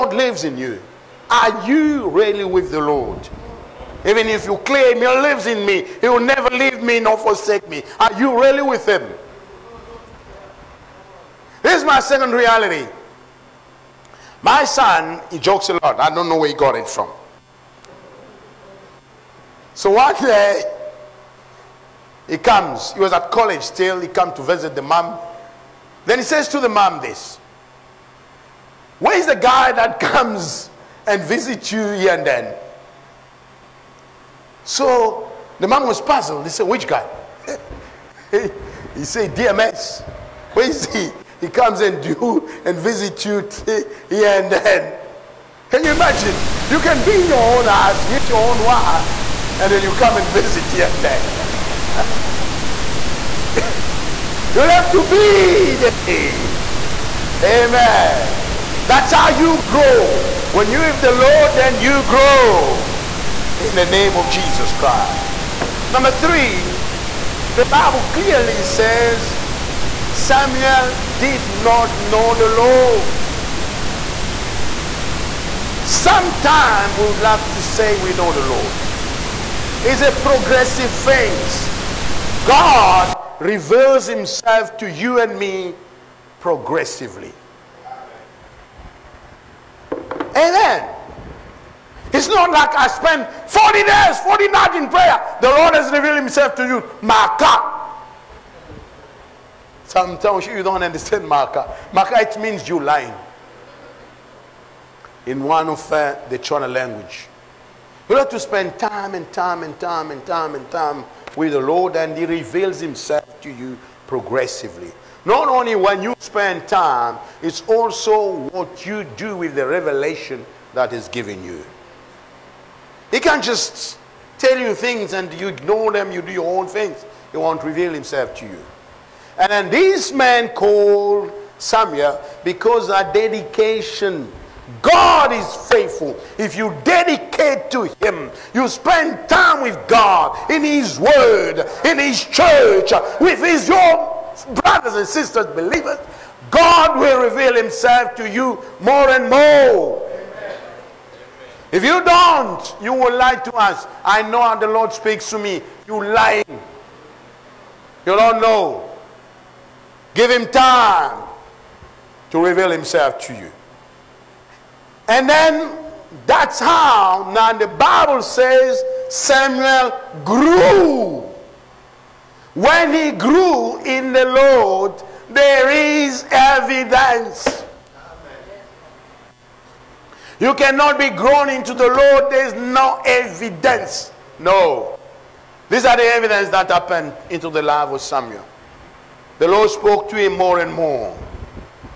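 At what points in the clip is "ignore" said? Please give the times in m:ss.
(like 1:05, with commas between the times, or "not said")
2:05.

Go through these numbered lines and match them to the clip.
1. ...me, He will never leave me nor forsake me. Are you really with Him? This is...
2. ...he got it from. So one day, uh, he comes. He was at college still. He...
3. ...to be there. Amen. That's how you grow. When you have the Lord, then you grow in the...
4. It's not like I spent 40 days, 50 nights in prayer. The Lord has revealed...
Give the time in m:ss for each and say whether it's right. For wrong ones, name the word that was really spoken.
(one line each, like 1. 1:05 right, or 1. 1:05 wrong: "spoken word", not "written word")
1. 0:05 right
2. 0:16 right
3. 0:54 right
4. 1:32 wrong: "40", not "50".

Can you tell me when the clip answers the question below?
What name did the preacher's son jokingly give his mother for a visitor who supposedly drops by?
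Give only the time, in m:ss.
0:39.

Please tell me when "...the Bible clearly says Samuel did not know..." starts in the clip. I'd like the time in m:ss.
1:07.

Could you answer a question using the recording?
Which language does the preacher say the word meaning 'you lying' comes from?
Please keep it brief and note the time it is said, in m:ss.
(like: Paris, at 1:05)
Shona, at 1:46.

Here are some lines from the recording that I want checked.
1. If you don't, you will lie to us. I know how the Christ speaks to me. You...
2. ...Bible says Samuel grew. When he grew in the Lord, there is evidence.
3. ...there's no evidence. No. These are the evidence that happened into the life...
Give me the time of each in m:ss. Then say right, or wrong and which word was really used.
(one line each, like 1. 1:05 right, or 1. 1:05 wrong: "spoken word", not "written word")
1. 2:31 wrong: "Lord", not "Christ"
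2. 2:47 right
3. 3:02 right.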